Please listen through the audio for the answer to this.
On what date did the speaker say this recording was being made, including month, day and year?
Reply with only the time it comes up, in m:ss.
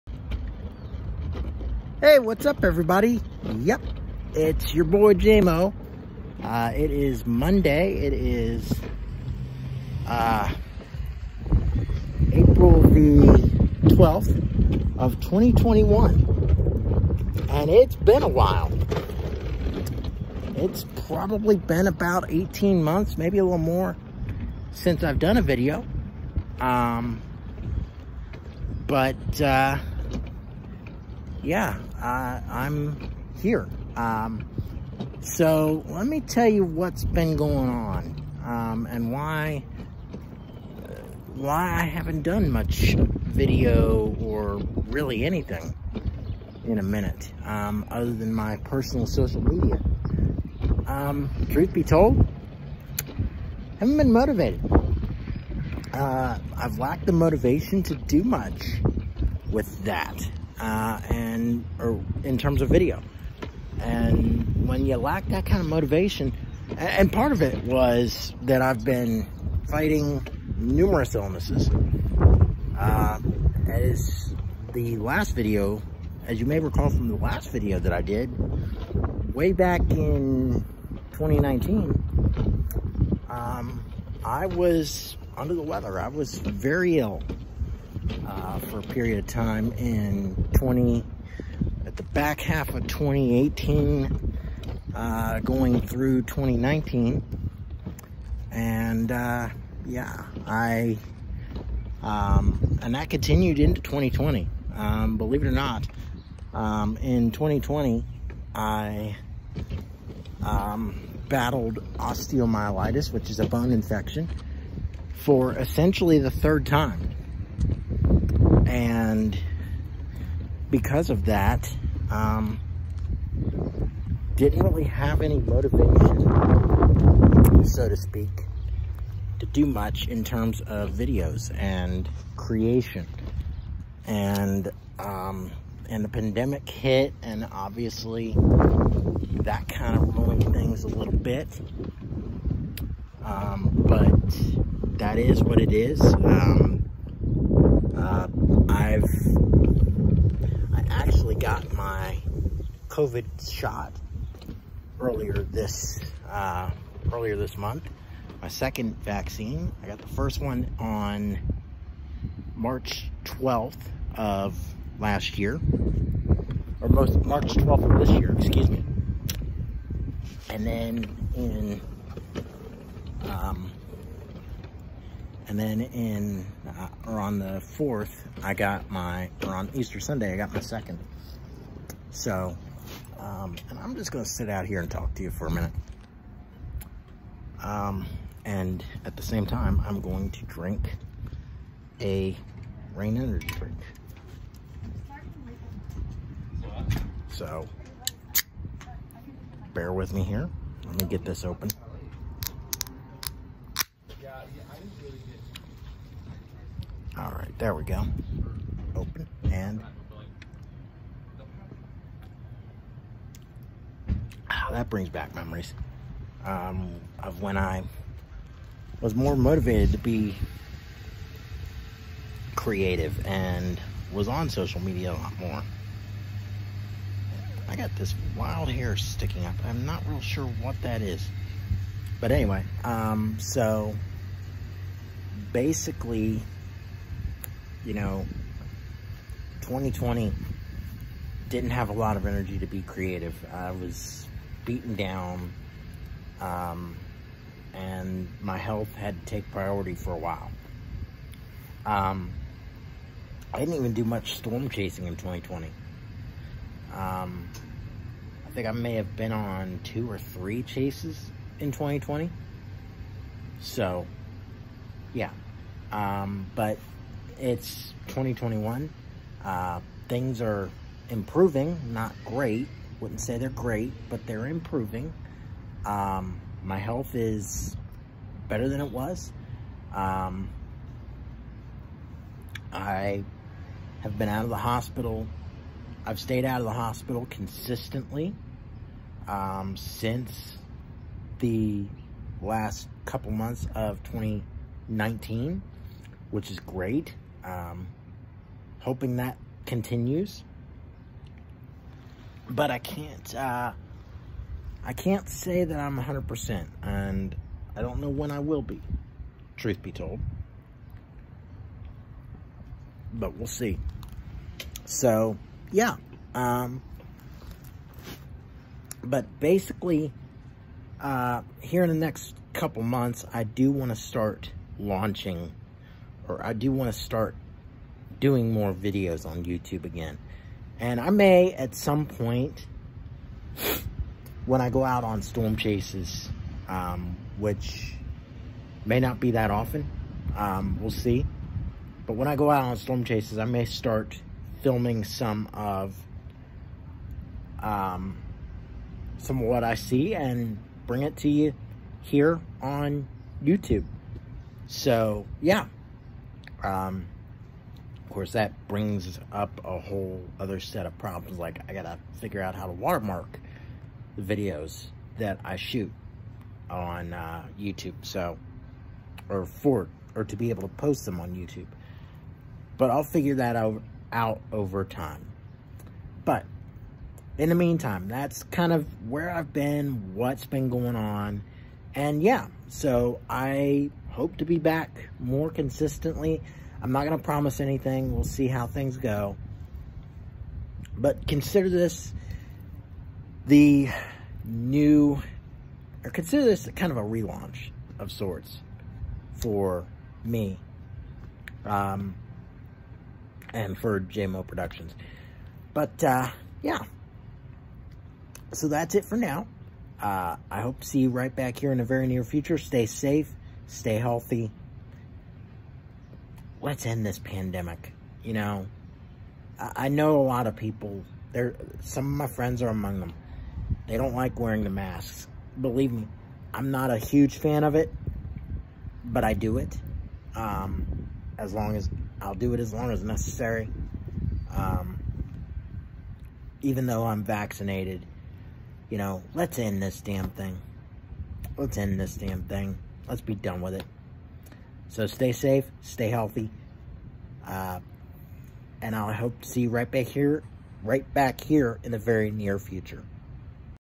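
0:12.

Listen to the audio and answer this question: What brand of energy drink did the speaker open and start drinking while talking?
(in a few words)
Reign.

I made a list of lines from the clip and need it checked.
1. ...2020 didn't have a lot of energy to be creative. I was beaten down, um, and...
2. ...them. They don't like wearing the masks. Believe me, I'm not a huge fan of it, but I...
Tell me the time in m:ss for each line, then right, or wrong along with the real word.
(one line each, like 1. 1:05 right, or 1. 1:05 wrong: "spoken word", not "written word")
1. 3:59 right
2. 7:02 right.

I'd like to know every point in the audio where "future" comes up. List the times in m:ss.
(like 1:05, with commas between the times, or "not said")
6:52, 7:32.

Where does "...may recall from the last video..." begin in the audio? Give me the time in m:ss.
1:16.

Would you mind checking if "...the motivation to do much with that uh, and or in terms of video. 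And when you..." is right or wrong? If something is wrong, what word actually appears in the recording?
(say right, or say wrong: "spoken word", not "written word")
right.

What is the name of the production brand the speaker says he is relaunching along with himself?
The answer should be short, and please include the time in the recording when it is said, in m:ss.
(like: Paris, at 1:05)
JMO Productions, at 6:43.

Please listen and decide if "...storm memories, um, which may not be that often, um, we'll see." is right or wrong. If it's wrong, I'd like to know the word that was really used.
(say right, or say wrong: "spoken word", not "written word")
wrong: "chases", not "memories".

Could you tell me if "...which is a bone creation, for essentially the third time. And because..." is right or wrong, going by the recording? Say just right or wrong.
wrong.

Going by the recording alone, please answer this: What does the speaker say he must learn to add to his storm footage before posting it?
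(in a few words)
Watermark.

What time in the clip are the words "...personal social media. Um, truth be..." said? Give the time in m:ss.
0:48.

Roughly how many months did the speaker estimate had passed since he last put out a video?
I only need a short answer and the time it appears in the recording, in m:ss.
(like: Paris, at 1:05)
18 months, at 0:22.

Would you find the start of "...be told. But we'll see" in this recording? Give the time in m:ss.
5:09.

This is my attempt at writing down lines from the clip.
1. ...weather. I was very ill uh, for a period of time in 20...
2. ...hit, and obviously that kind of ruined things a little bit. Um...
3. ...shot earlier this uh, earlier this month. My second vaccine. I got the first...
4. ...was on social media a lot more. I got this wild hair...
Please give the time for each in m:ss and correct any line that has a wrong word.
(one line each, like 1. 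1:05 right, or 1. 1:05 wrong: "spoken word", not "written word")
1. 1:25 right
2. 2:16 right
3. 2:33 right
4. 3:44 right.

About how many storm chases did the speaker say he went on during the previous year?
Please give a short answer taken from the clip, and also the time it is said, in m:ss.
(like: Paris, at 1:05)
2 or 3, at 4:19.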